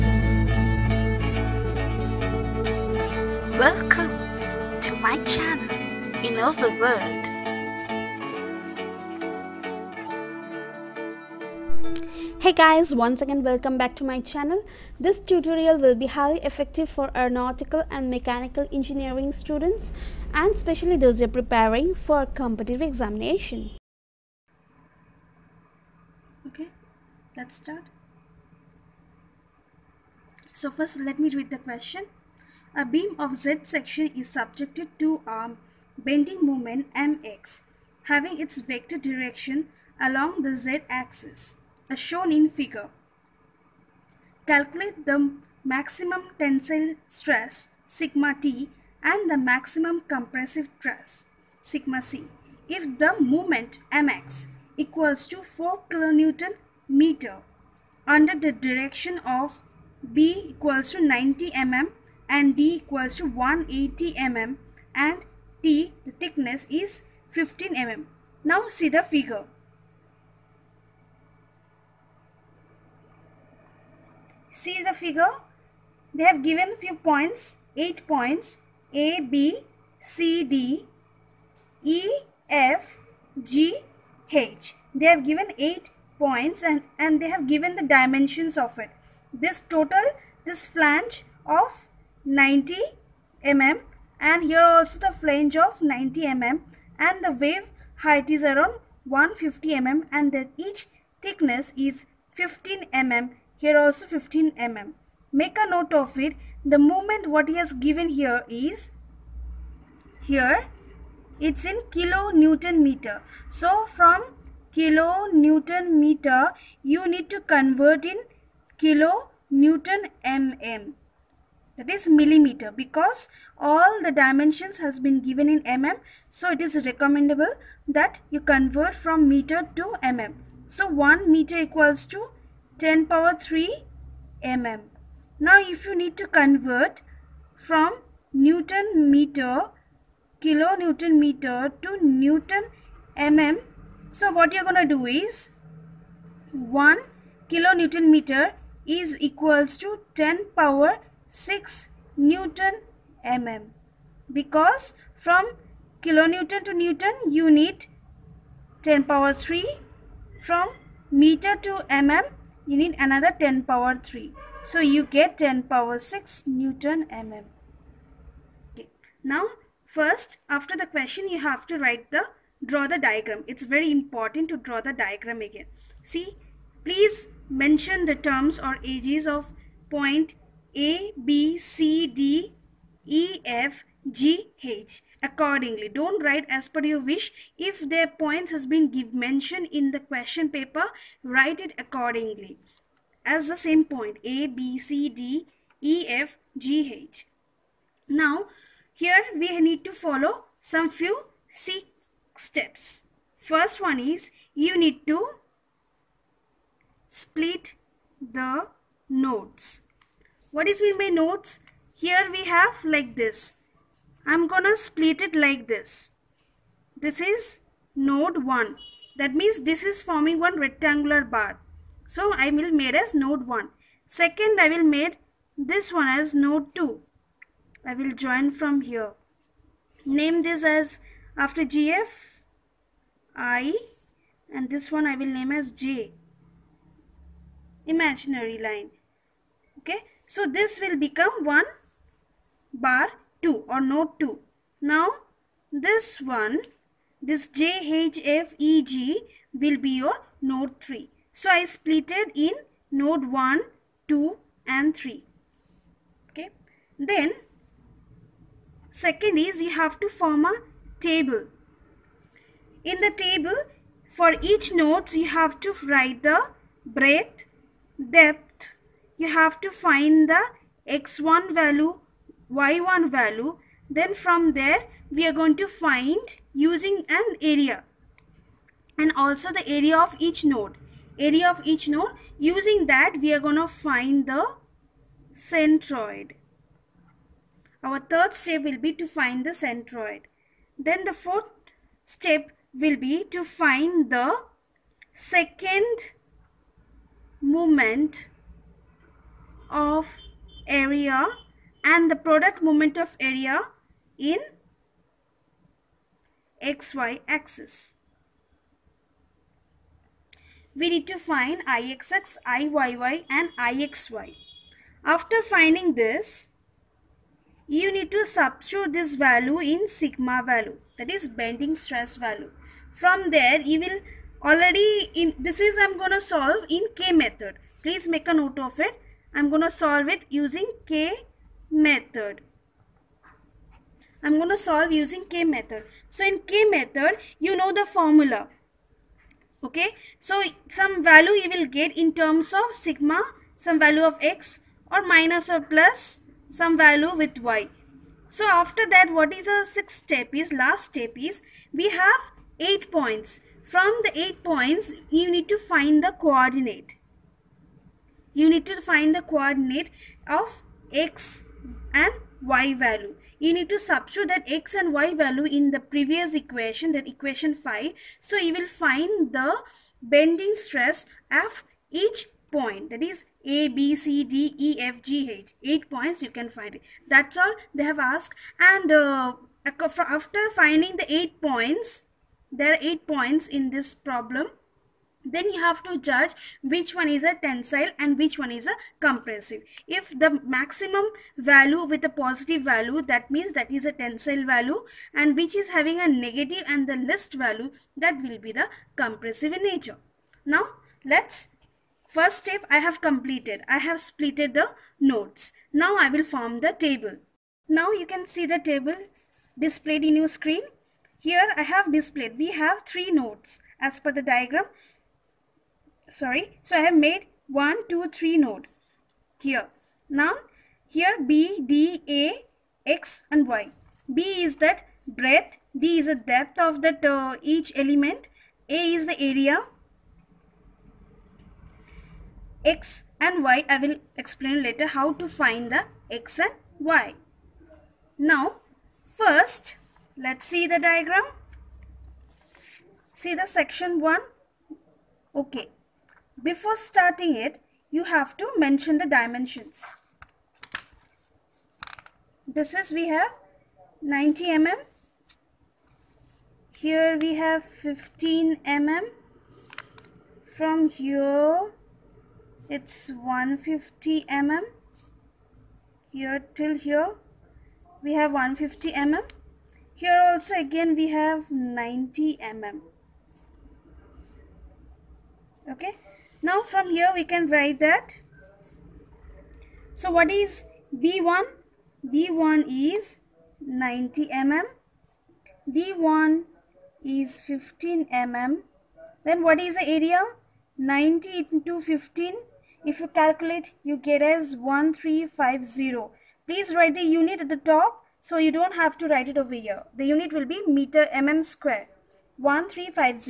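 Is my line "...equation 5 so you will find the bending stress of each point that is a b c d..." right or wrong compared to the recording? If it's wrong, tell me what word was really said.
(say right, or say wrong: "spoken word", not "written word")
right.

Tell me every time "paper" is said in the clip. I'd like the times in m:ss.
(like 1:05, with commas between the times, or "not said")
3:10.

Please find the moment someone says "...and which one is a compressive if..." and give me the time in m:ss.
6:27.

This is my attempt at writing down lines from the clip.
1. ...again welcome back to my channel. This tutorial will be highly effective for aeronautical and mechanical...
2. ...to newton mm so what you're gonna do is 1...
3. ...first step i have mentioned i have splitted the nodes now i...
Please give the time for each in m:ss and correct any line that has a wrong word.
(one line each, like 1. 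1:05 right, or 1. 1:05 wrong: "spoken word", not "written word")
1. 0:13 right
2. 2:21 right
3. 6:42 wrong: "completed", not "mentioned".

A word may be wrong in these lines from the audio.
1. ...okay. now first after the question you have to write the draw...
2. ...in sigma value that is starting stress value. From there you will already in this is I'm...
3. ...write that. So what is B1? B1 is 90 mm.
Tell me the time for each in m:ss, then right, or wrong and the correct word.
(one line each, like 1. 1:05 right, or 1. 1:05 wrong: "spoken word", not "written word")
1. 2:47 right
2. 5:19 wrong: "bending", not "starting"
3. 7:57 right.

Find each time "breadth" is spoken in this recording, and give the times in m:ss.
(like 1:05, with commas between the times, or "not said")
4:26, 7:05.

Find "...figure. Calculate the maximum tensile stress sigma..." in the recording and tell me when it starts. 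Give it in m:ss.
0:42.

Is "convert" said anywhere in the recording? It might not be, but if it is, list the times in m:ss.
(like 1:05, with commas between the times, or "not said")
1:57, 2:08, 2:16.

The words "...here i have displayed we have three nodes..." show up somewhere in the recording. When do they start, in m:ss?
6:51.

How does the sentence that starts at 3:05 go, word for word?
Don't write as per your wish.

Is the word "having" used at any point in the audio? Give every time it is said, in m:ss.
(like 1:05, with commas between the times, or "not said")
0:38, 6:35.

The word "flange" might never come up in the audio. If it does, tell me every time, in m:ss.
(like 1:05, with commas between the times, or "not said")
1:30, 1:35.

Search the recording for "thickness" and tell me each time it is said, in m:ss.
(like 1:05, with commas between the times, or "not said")
1:06, 1:41.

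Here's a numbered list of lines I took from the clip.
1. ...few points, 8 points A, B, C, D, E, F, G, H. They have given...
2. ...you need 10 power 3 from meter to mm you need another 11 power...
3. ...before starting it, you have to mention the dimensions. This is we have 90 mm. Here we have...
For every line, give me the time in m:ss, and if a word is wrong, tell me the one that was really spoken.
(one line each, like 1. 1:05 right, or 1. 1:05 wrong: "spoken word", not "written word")
1. 1:16 right
2. 2:37 wrong: "10", not "11"
3. 7:26 right.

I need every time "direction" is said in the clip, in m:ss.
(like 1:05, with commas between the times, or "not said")
0:39, 0:58.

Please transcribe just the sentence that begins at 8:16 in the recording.
Please write the unit at the top so you don't have to write it over here.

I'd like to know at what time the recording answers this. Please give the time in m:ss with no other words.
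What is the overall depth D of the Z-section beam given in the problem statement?
1:02.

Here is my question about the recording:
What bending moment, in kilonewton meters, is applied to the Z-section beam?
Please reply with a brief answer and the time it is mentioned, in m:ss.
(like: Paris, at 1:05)
4 kilonewton meter, at 0:55.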